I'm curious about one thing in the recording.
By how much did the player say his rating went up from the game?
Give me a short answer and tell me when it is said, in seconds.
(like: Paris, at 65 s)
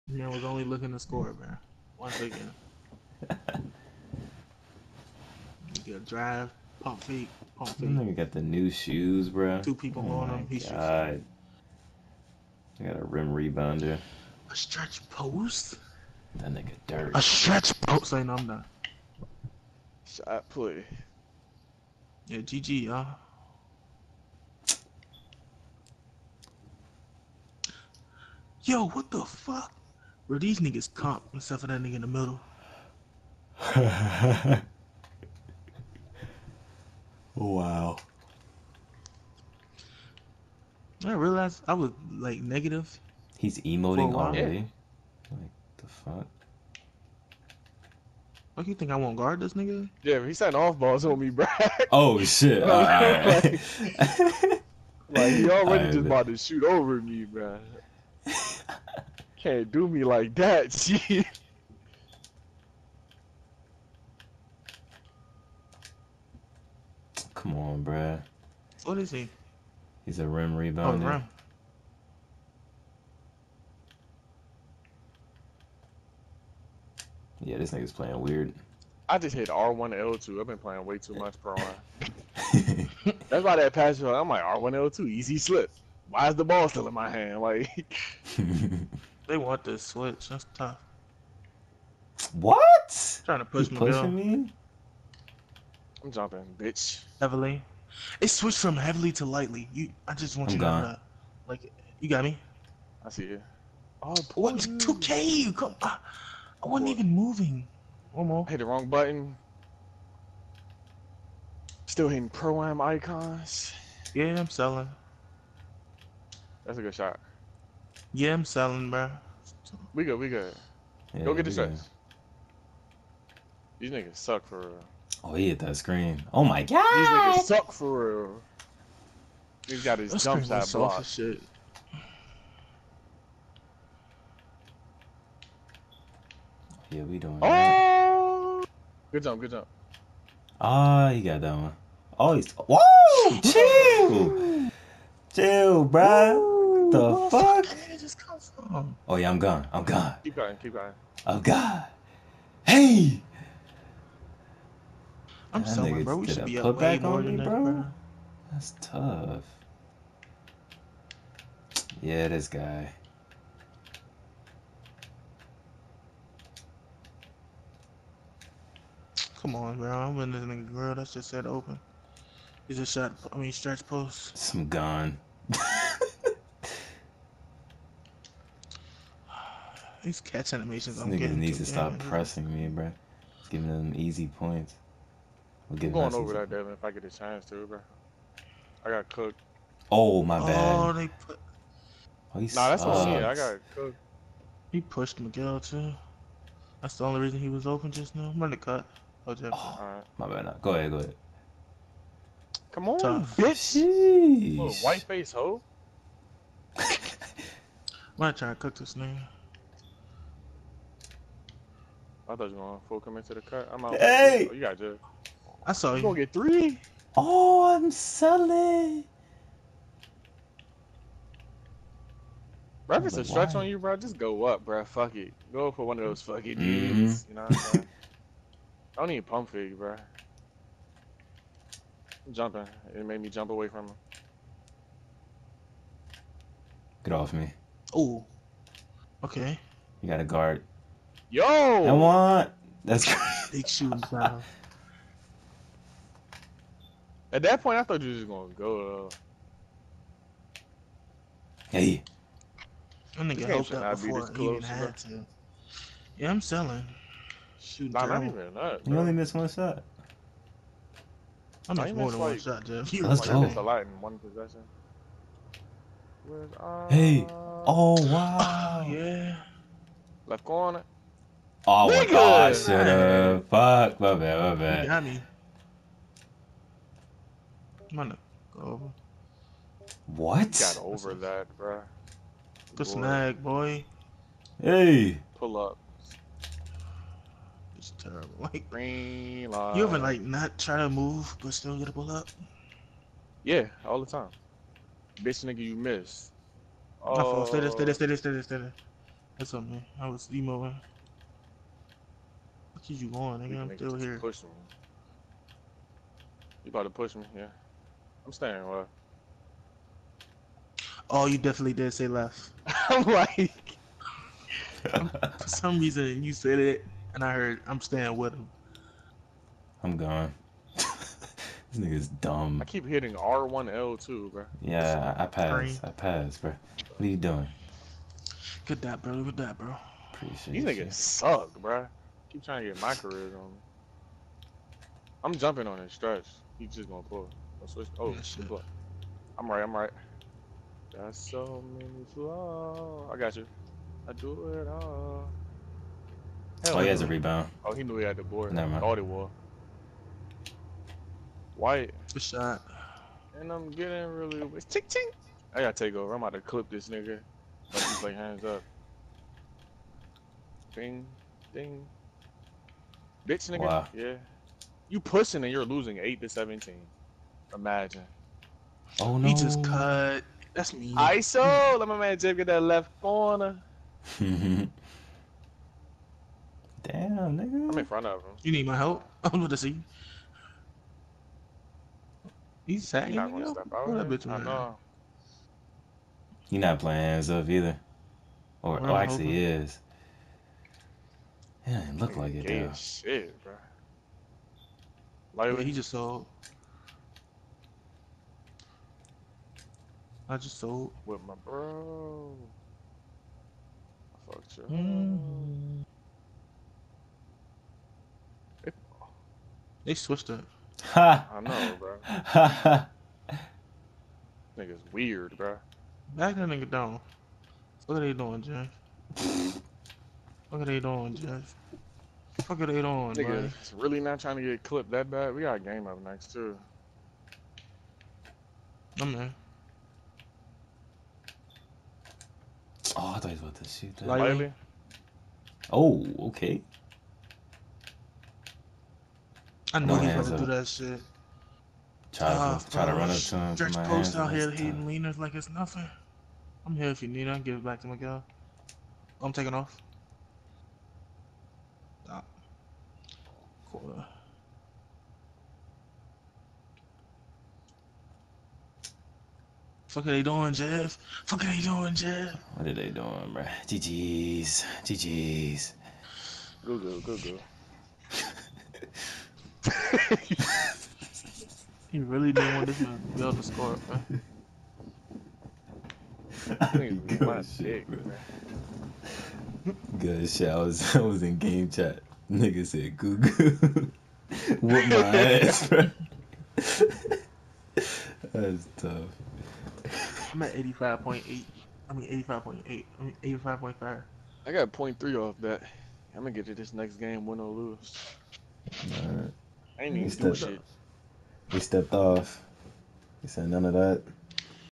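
0.3, at 494 s.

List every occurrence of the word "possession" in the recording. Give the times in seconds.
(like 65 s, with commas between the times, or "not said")
264 s.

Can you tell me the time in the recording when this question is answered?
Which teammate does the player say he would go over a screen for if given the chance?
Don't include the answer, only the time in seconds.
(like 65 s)
186 s.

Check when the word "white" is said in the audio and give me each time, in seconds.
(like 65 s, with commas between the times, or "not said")
204 s, 351 s.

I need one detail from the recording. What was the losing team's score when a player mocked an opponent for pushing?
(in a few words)
8 to 17.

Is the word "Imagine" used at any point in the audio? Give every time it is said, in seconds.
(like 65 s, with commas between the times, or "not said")
367 s.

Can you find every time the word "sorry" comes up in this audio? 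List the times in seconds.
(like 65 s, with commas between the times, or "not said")
155 s.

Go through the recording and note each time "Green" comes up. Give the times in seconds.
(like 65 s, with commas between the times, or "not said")
288 s, 325 s.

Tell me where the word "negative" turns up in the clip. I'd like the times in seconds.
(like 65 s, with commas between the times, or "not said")
42 s.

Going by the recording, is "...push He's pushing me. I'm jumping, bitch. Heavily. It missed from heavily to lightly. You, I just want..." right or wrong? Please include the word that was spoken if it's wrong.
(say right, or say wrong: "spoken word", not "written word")
wrong: "switched", not "missed".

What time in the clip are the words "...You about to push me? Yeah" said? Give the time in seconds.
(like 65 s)
306 s.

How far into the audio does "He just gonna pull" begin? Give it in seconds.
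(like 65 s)
336 s.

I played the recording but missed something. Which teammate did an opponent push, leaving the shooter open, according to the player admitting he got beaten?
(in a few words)
Miguel.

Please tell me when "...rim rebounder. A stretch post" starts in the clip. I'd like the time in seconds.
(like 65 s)
13 s.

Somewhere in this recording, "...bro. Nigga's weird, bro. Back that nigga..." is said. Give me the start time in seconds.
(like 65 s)
411 s.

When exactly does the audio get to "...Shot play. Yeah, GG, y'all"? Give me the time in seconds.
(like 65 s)
20 s.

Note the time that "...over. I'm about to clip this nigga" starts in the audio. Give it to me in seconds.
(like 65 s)
355 s.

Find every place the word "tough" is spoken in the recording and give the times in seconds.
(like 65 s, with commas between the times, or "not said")
90 s, 158 s, 202 s, 488 s.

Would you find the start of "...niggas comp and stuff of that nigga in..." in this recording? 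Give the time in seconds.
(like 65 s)
30 s.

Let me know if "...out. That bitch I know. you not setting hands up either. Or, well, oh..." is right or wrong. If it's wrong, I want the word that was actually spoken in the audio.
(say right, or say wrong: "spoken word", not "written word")
wrong: "playing", not "setting".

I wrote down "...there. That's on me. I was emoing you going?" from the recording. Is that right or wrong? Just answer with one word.
right.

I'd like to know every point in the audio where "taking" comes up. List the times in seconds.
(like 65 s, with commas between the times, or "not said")
449 s.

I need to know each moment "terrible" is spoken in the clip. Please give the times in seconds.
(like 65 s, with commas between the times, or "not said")
287 s.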